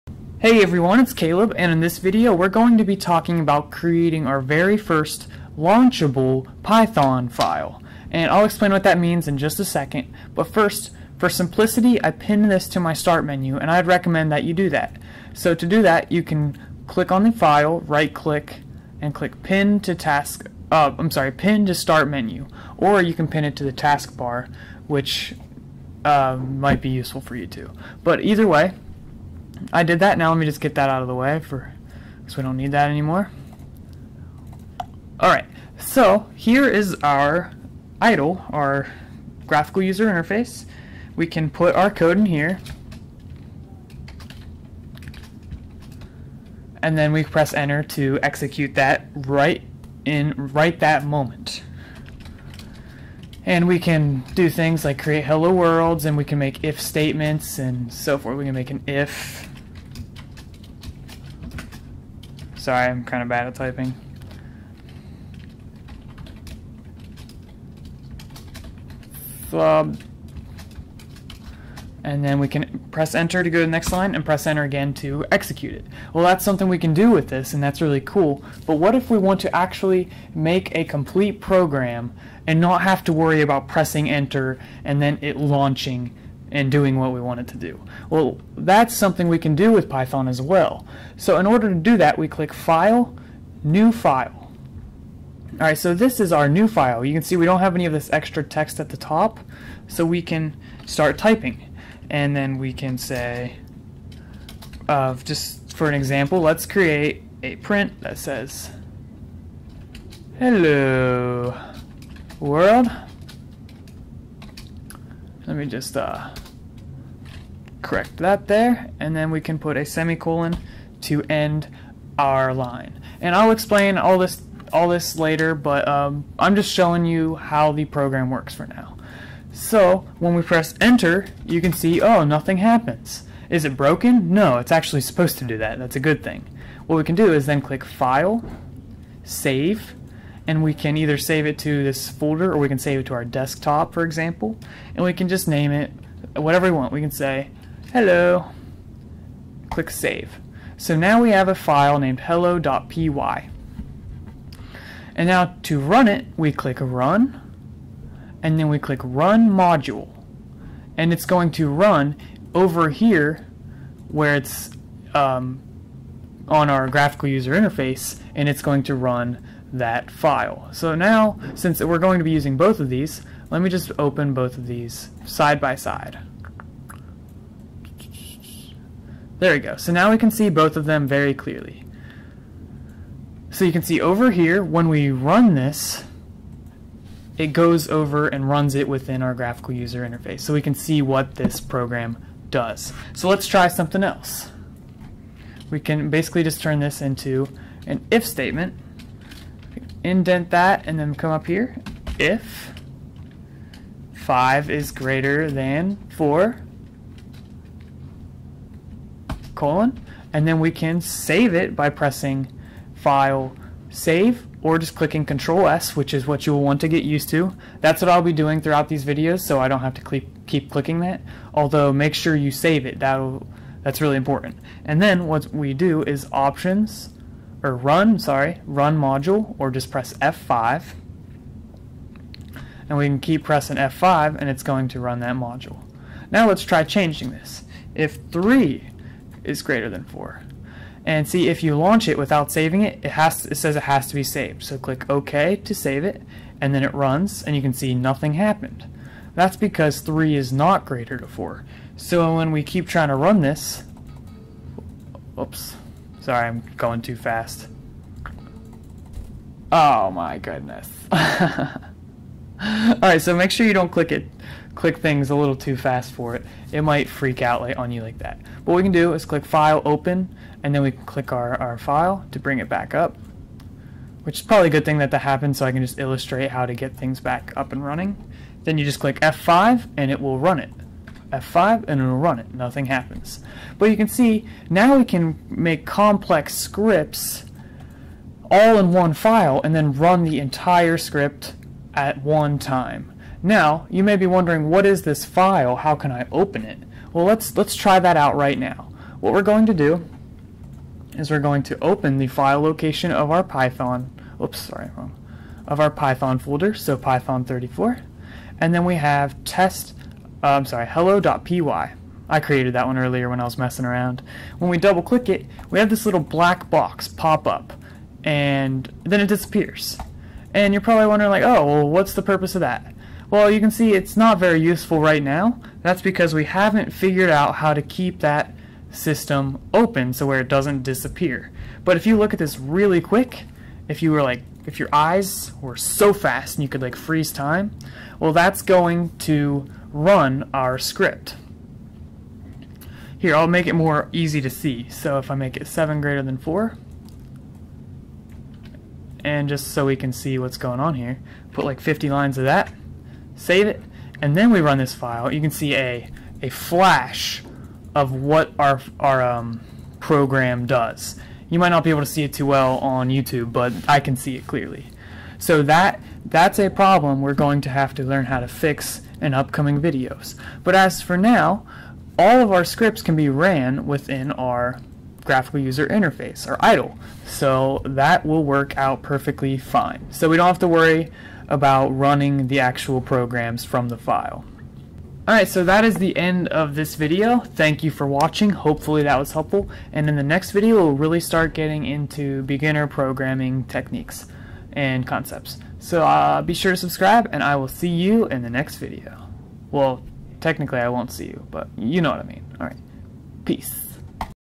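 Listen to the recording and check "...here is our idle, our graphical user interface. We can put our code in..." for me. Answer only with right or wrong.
right.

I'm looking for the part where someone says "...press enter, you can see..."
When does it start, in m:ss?
2:10.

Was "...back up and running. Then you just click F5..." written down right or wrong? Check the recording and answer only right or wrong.
right.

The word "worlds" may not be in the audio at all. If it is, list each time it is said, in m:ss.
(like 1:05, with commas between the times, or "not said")
0:55, 1:52.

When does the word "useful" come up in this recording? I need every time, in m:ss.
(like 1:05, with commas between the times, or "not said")
0:26, 5:24.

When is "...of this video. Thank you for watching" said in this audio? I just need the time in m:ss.
6:26.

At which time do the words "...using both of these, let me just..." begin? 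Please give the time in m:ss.
2:52.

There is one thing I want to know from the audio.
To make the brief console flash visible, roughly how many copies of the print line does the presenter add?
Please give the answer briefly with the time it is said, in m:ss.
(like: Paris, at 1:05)
50, at 5:51.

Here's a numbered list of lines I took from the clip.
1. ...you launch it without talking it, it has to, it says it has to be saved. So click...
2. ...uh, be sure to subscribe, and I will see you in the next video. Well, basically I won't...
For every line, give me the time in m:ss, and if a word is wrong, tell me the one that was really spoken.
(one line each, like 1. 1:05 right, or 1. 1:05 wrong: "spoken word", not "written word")
1. 4:01 wrong: "saving", not "talking"
2. 6:36 wrong: "technically", not "basically".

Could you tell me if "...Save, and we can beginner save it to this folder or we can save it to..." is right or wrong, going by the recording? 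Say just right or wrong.
wrong.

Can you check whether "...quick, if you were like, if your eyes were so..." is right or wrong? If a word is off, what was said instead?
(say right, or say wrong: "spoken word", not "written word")
right.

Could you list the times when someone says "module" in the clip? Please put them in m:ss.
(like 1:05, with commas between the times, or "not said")
2:39, 3:48, 3:55.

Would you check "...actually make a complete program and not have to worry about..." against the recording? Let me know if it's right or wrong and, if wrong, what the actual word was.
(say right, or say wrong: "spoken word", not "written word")
right.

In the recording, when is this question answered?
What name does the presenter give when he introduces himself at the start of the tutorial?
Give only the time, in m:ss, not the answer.
0:01.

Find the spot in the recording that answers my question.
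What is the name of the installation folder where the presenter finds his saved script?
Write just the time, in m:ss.
5:06.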